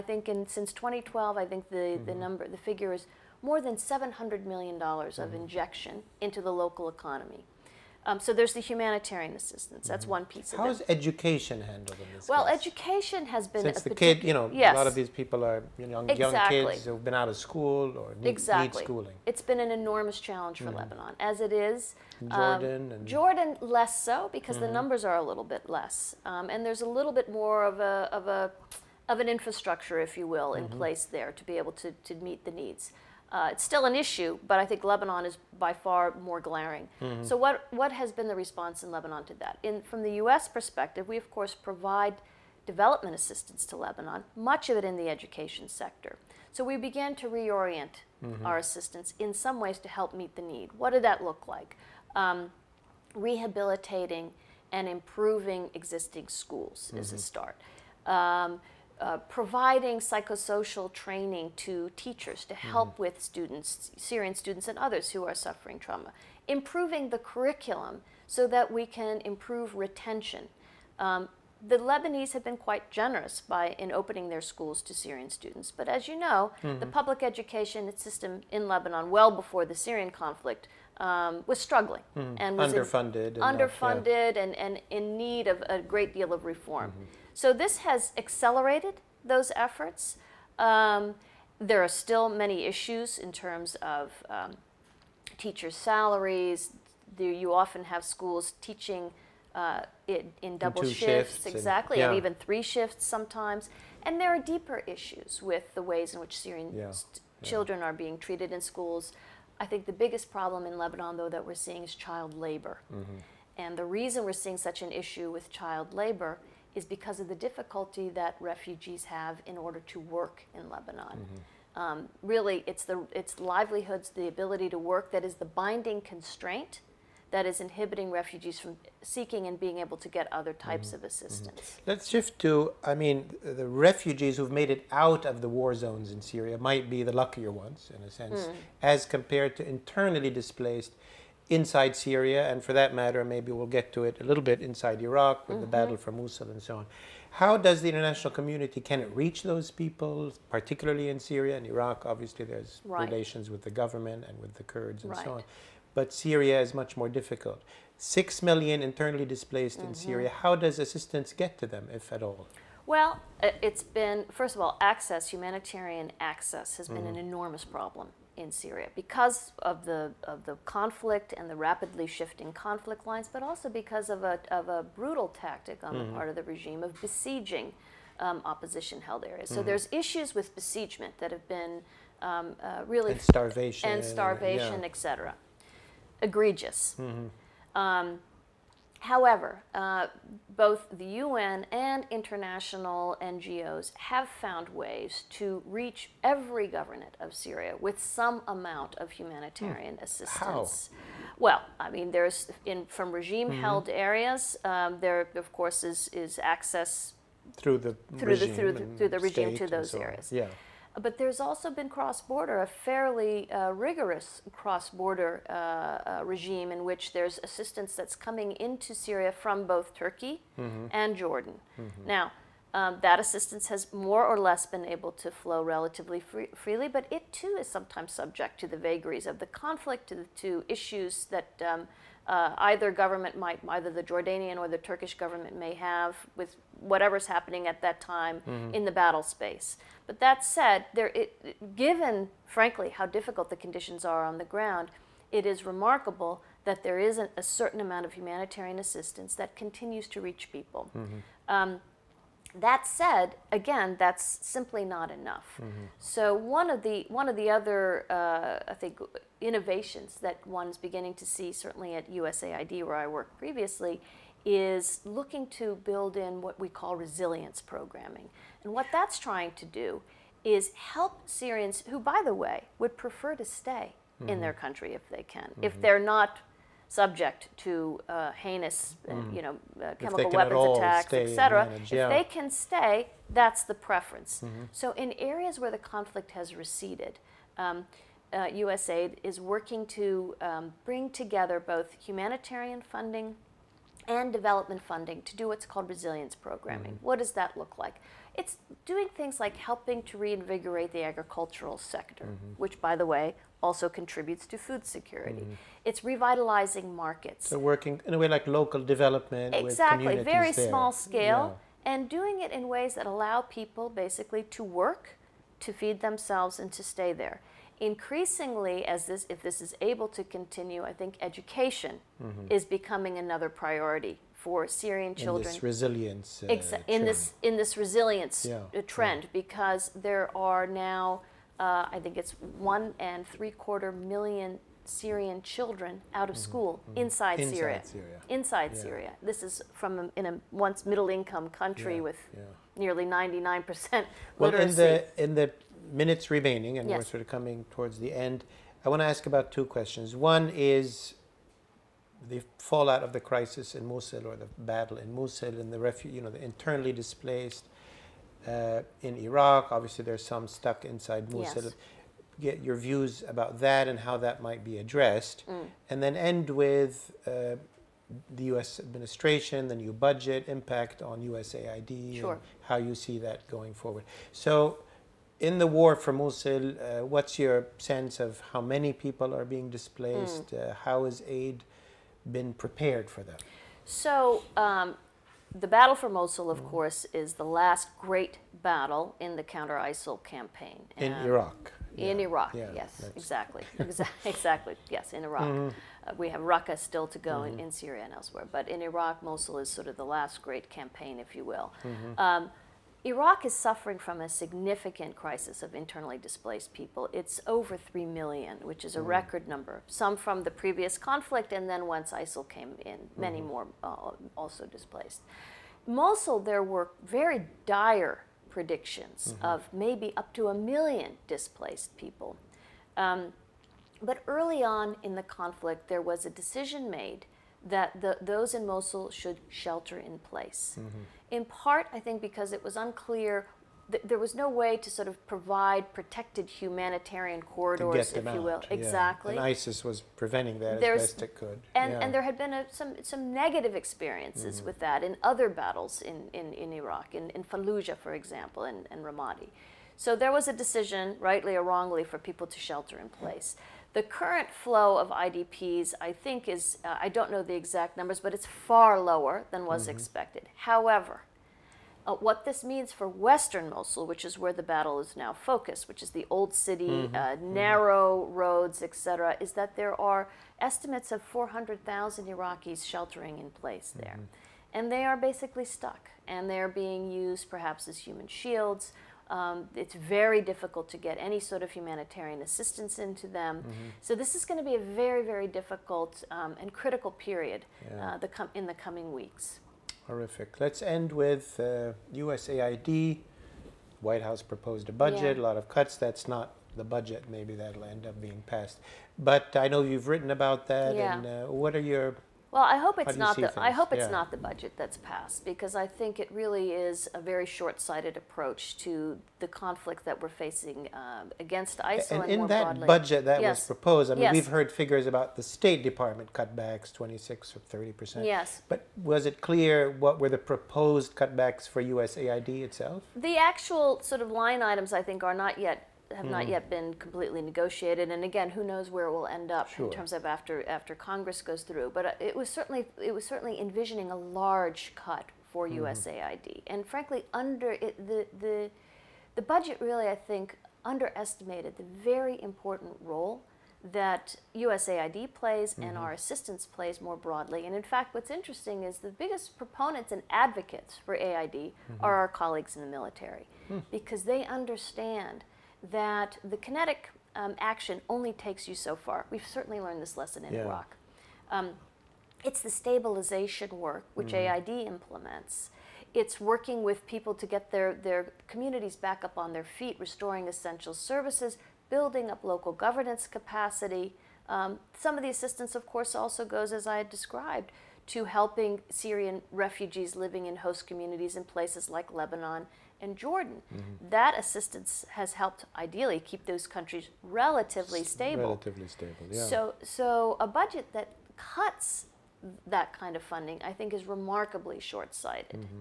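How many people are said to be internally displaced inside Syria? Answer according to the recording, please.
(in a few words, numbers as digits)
6 million.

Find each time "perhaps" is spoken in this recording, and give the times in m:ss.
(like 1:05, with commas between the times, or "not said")
7:57.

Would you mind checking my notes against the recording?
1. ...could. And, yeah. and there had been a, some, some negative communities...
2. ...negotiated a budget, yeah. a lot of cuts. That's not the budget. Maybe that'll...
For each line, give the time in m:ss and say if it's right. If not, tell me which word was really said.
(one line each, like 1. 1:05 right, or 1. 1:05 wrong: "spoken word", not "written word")
1. 7:21 wrong: "experiences", not "communities"
2. 8:14 wrong: "proposed", not "negotiated".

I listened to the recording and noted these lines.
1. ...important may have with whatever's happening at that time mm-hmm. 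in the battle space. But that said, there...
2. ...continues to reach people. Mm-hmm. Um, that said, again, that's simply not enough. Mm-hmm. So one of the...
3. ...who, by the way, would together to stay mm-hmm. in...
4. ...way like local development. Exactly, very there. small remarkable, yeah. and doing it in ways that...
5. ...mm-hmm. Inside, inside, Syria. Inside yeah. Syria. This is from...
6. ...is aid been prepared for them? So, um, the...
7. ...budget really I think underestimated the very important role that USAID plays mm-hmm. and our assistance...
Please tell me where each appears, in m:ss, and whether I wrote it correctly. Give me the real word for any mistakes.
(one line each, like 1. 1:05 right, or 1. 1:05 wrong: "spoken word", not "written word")
1. 3:55 wrong: "government", not "important"
2. 4:09 right
3. 4:31 wrong: "prefer", not "together"
4. 5:08 wrong: "scale", not "remarkable"
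5. 5:36 right
6. 6:21 right
7. 8:59 right.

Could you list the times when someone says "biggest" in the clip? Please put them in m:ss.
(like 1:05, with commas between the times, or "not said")
1:49, 9:09.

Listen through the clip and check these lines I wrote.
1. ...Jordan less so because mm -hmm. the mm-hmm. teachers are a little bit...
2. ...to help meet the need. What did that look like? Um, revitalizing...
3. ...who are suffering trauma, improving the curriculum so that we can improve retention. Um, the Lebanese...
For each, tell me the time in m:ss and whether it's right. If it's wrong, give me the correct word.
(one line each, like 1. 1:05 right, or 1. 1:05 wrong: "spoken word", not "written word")
1. 0:23 wrong: "numbers", not "teachers"
2. 0:49 wrong: "rehabilitating", not "revitalizing"
3. 1:05 right.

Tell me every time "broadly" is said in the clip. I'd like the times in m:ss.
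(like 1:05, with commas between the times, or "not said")
8:32, 9:07.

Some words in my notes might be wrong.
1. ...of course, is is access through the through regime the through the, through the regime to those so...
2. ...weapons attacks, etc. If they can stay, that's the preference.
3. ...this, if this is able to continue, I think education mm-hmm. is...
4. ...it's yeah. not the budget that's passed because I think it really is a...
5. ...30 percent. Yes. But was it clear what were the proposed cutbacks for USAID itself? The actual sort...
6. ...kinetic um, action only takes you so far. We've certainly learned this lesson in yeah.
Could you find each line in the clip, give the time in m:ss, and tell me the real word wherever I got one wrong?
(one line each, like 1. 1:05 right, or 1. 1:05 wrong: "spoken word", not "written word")
1. 3:25 right
2. 4:40 right
3. 5:19 right
4. 8:23 right
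5. 8:37 right
6. 9:16 right.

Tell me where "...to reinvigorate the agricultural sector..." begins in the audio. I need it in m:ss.
5:00.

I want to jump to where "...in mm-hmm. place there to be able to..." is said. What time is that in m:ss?
0:30.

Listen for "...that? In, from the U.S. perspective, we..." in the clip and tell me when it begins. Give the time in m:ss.
0:39.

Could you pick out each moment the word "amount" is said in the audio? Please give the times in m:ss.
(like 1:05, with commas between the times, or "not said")
3:18, 4:07.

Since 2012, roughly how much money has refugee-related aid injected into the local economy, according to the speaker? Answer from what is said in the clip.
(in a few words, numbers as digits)
more than $700 million.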